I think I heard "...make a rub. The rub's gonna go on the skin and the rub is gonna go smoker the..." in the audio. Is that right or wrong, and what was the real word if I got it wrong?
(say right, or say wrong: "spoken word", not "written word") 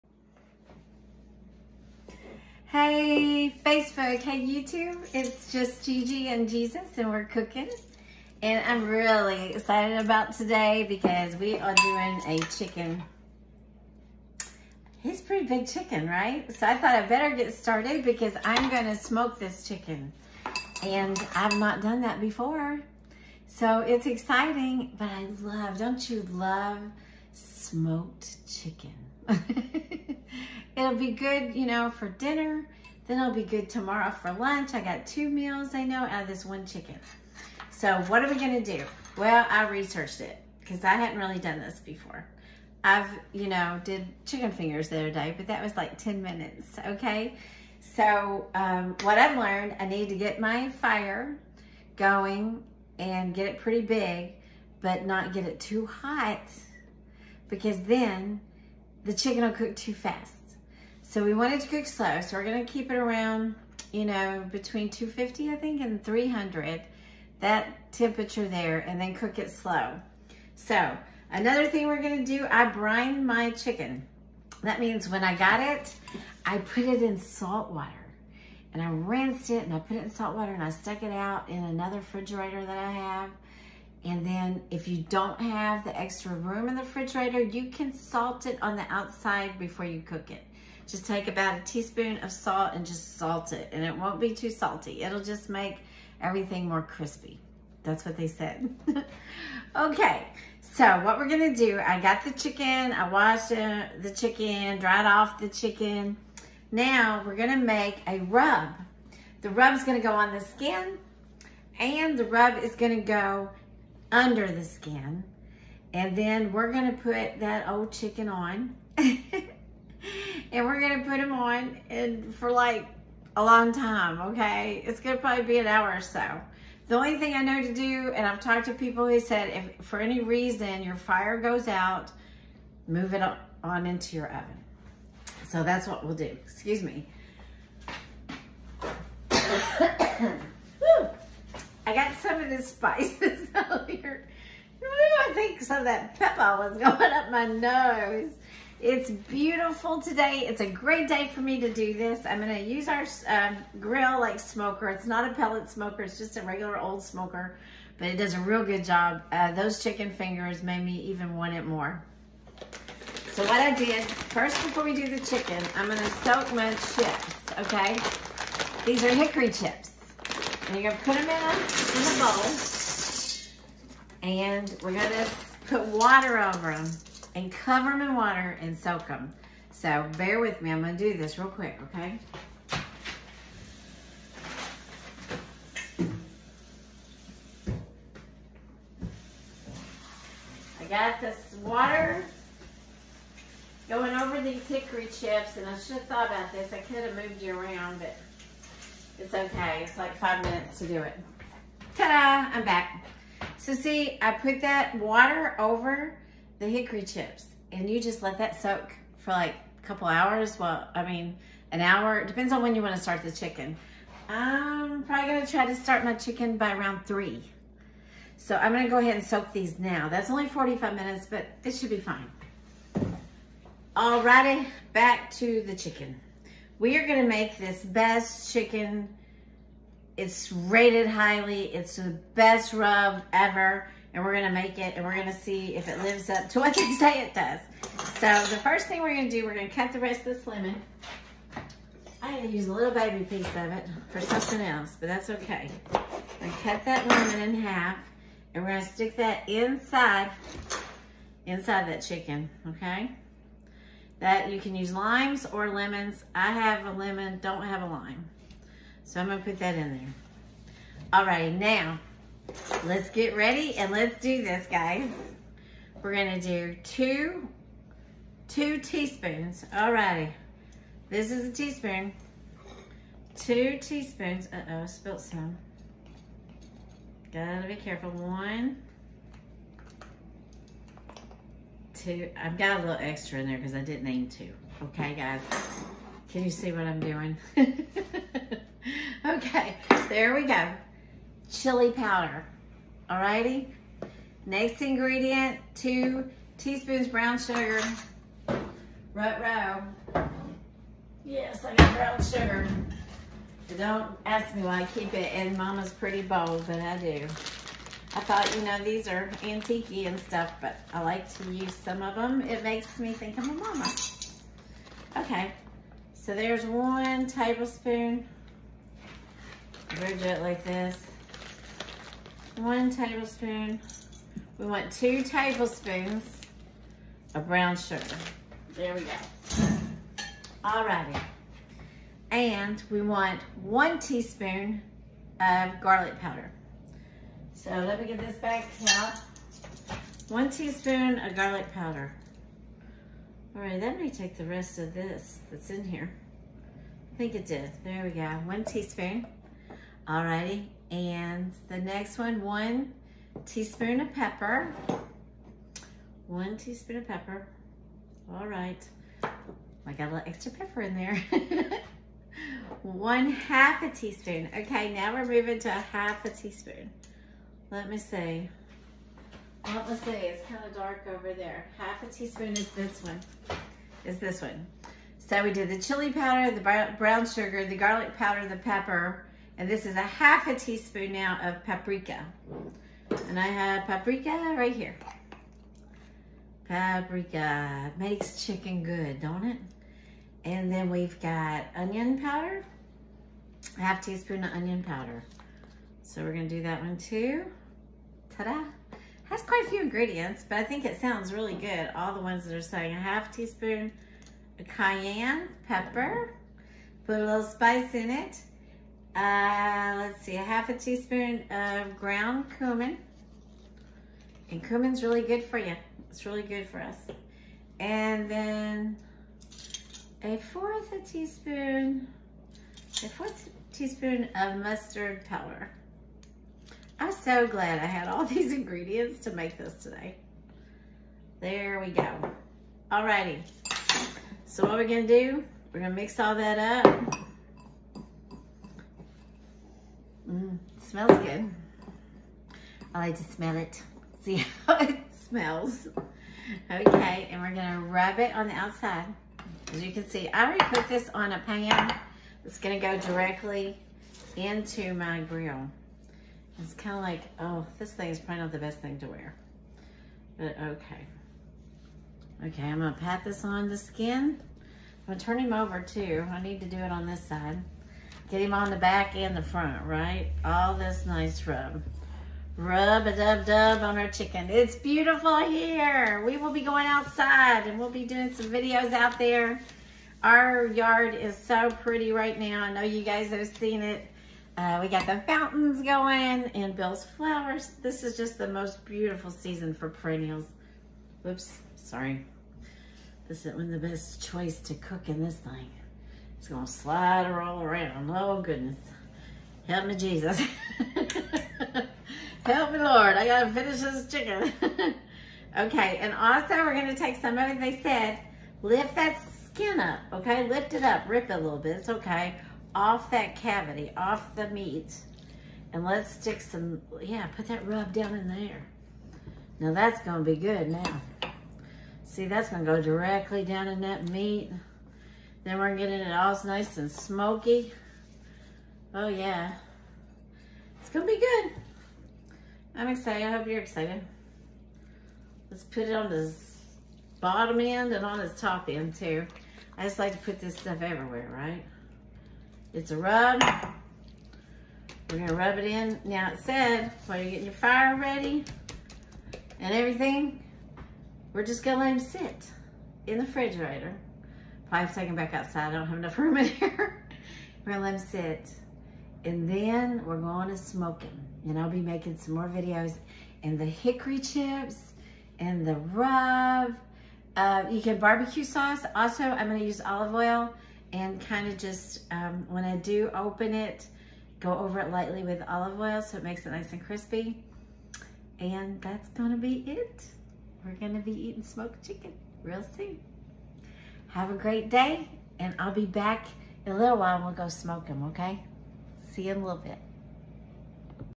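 wrong: "under", not "smoker".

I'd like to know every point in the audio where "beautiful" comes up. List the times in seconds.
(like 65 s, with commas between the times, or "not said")
149 s, 474 s, 488 s.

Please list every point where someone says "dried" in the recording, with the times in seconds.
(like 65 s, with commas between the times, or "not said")
104 s.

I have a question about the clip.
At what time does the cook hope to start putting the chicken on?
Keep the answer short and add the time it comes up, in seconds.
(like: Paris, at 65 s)
3, at 216 s.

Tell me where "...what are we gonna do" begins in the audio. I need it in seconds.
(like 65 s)
38 s.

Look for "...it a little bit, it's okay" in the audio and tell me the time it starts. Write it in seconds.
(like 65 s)
511 s.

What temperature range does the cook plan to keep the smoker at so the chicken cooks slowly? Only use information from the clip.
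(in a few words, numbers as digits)
250 to 300.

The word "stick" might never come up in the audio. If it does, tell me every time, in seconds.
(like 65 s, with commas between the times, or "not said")
248 s, 516 s.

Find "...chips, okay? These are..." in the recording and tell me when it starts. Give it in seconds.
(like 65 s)
166 s.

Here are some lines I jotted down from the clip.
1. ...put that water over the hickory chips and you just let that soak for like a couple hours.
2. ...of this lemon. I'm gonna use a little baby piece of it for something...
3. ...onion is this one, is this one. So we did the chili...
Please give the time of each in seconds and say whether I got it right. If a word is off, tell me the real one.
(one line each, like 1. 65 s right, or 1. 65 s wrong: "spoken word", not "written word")
1. 204 s right
2. 240 s right
3. 372 s wrong: "teaspoon", not "onion".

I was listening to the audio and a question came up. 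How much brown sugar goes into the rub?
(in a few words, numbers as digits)
2 tablespoons.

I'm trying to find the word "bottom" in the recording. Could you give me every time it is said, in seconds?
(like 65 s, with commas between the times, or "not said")
537 s.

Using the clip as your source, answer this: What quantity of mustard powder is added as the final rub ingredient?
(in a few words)
1/4 teaspoon.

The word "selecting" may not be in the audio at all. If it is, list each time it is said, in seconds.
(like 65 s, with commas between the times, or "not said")
not said.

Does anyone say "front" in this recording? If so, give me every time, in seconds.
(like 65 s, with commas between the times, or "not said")
469 s.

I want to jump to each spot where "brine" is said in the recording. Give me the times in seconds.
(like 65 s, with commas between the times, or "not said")
72 s.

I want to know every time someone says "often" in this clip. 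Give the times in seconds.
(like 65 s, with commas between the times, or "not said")
not said.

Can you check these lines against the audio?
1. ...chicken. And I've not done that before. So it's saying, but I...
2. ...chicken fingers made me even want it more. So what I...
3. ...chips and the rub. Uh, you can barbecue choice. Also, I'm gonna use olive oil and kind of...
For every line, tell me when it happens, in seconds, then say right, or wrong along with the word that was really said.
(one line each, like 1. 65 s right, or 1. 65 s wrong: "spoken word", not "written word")
1. 19 s wrong: "exciting", not "saying"
2. 159 s right
3. 564 s wrong: "sauce", not "choice".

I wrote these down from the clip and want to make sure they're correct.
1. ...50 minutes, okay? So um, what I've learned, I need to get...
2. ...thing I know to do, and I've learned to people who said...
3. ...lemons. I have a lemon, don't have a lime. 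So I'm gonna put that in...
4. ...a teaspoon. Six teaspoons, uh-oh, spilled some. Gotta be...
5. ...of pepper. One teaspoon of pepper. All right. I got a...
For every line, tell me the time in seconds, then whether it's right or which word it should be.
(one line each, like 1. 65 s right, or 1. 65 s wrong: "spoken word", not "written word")
1. 45 s wrong: "10", not "50"
2. 127 s wrong: "talked", not "learned"
3. 255 s right
4. 271 s wrong: "Two", not "Six"
5. 354 s right.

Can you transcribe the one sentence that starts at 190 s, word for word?
I got this water going over these hickory chips, and I should have thought about this.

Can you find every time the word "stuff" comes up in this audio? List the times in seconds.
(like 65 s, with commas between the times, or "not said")
310 s, 540 s.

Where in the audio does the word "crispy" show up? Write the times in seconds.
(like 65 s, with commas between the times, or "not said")
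96 s, 576 s.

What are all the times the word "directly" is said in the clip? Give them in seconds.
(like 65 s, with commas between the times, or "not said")
452 s, 522 s.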